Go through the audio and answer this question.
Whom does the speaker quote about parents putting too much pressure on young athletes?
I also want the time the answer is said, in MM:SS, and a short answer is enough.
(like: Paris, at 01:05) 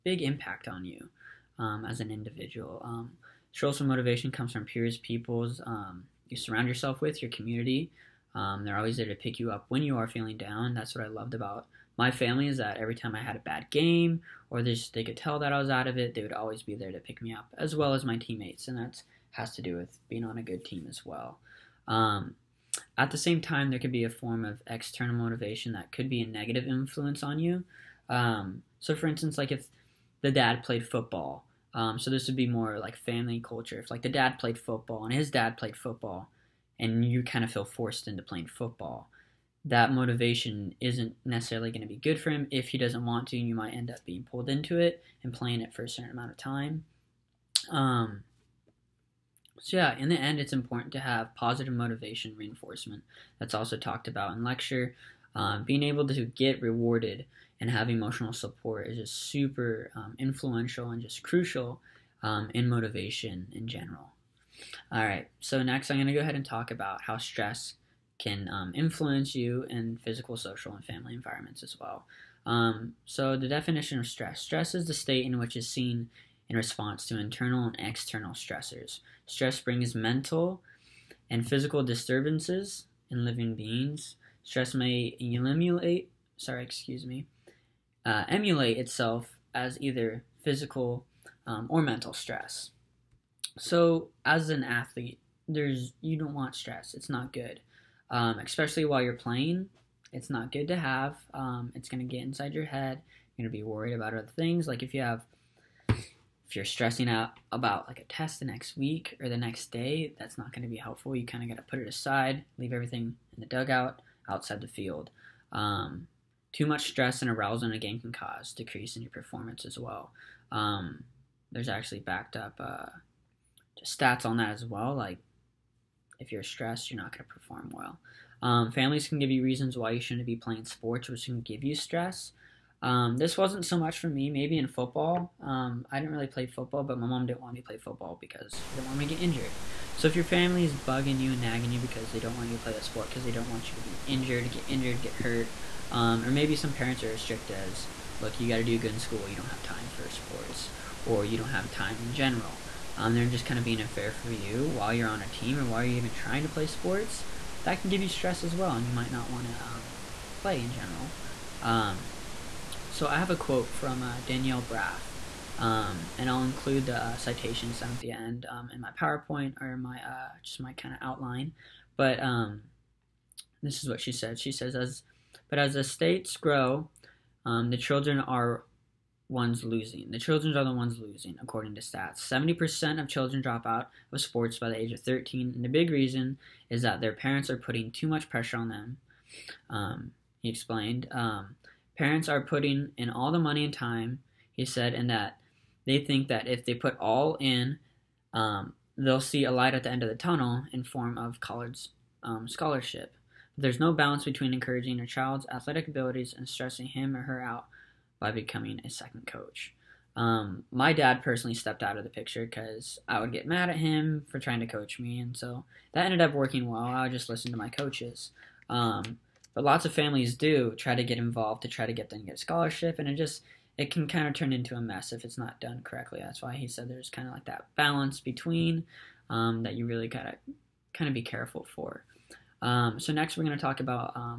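Danielle Braff, at 02:44.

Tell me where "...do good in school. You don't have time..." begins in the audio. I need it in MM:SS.
02:28.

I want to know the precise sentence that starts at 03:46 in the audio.
That's why he said there's kind of like that balance between um, that you really gotta kind of be careful for.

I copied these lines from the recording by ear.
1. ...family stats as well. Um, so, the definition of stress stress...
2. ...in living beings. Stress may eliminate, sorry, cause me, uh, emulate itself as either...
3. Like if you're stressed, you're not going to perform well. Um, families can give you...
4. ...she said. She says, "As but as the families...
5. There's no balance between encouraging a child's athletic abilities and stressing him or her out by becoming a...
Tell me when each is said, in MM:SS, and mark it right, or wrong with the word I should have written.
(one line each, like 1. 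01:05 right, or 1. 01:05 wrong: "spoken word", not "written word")
1. 01:10 wrong: "environments", not "stats"
2. 01:23 wrong: "excuse", not "cause"
3. 02:04 right
4. 02:53 wrong: "states", not "families"
5. 03:23 right.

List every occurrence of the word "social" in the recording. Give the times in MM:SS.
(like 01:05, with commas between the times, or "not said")
00:03, 01:10.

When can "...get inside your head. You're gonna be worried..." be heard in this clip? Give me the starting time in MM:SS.
01:42.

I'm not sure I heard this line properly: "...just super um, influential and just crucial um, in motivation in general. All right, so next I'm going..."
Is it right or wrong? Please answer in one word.
right.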